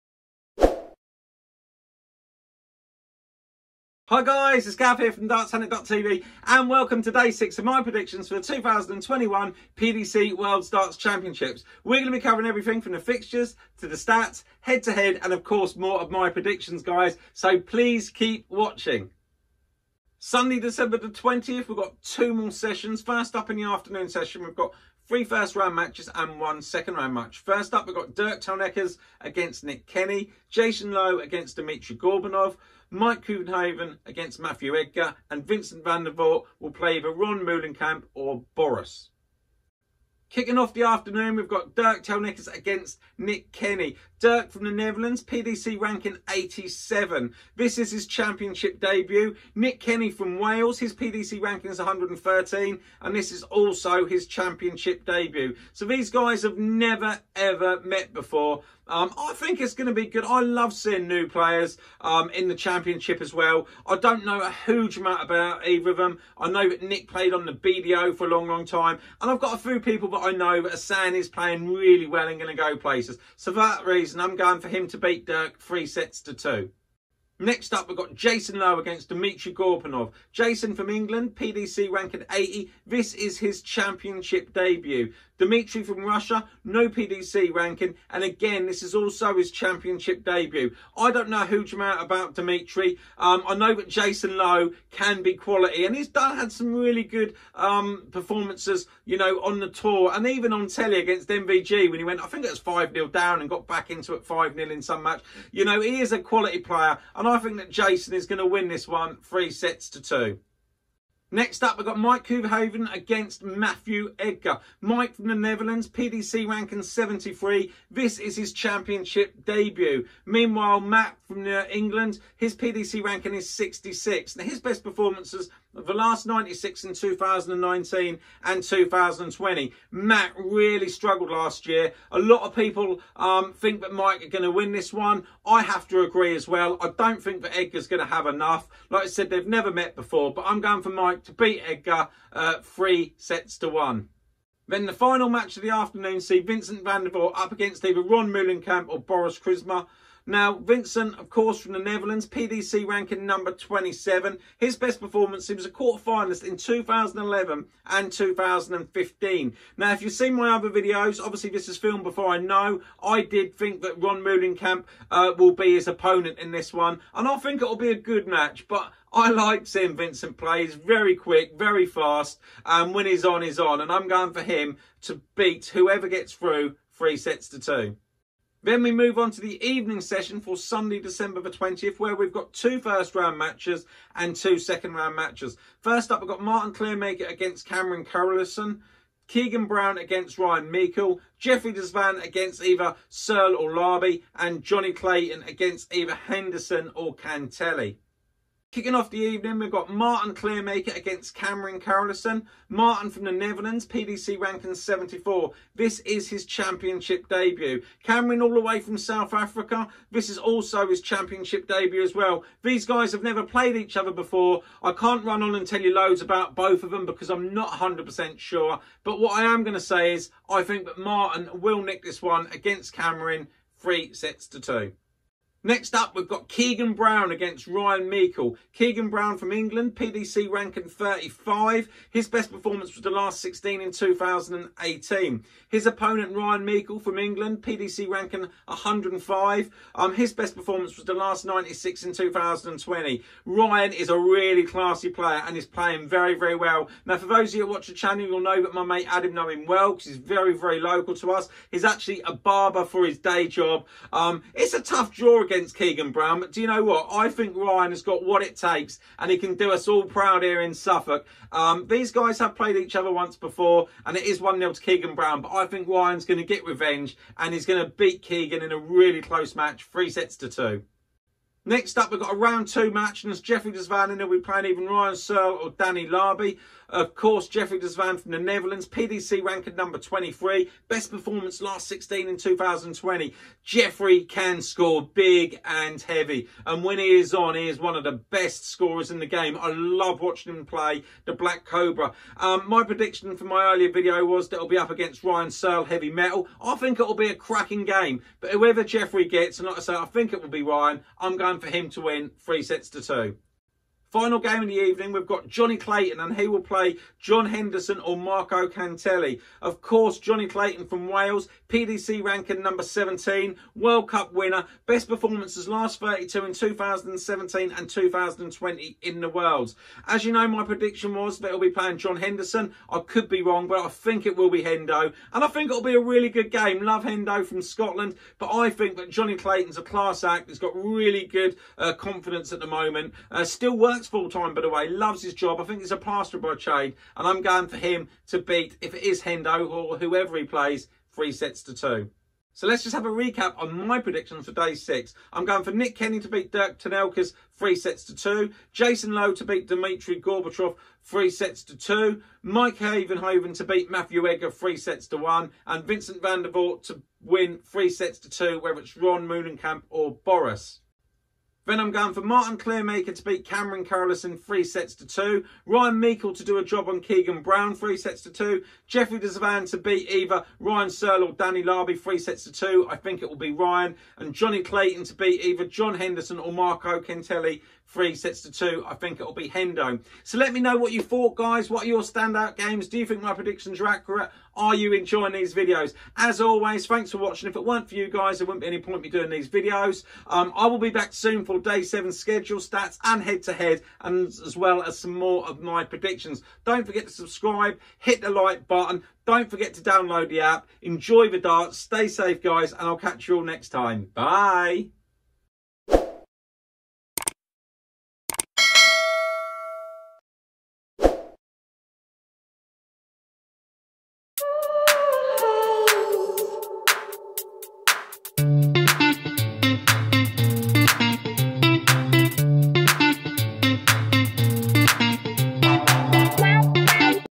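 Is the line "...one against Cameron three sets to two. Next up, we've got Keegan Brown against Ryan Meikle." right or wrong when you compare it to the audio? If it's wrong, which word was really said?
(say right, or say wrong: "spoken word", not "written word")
right.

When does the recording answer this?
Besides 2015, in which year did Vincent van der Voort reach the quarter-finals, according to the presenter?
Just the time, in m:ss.
2:36.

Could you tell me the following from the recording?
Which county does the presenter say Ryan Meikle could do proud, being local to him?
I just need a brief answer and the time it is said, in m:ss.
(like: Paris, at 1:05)
Suffolk, at 4:20.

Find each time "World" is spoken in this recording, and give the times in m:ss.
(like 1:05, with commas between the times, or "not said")
0:10, 5:13, 5:19.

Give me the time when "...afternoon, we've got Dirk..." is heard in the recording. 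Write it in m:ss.
0:40.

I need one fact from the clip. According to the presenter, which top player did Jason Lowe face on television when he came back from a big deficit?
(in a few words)
MVG.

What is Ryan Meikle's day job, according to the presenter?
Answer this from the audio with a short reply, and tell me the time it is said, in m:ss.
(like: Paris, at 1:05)
Barber, at 4:12.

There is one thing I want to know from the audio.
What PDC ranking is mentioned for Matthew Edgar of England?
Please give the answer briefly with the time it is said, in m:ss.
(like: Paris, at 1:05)
66, at 2:03.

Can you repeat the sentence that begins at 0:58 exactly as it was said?
Um, I think it's going to be good.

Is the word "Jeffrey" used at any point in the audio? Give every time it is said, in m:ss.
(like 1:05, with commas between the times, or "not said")
3:11, 4:33, 4:37, 4:43, 4:58, 6:08.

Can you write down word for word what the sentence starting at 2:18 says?
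Like I said, they've never met before, but I'm going for Mike to beat Edgar uh, three sets to one.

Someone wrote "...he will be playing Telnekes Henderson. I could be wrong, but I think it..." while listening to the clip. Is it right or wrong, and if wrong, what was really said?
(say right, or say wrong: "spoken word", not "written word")
wrong: "John", not "Telnekes".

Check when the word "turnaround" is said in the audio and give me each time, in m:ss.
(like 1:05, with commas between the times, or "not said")
not said.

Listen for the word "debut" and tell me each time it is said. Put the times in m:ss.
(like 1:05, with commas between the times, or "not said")
0:48, 0:55, 1:24, 1:30, 1:59, 3:27, 3:31.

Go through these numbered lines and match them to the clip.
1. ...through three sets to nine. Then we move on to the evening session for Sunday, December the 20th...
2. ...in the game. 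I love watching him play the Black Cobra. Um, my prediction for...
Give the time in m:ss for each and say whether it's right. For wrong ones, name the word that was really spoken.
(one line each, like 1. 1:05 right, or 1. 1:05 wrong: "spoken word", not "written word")
1. 2:56 wrong: "two", not "nine"
2. 4:49 right.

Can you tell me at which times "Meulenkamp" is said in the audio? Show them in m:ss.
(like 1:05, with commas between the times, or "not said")
0:37, 2:28, 2:44.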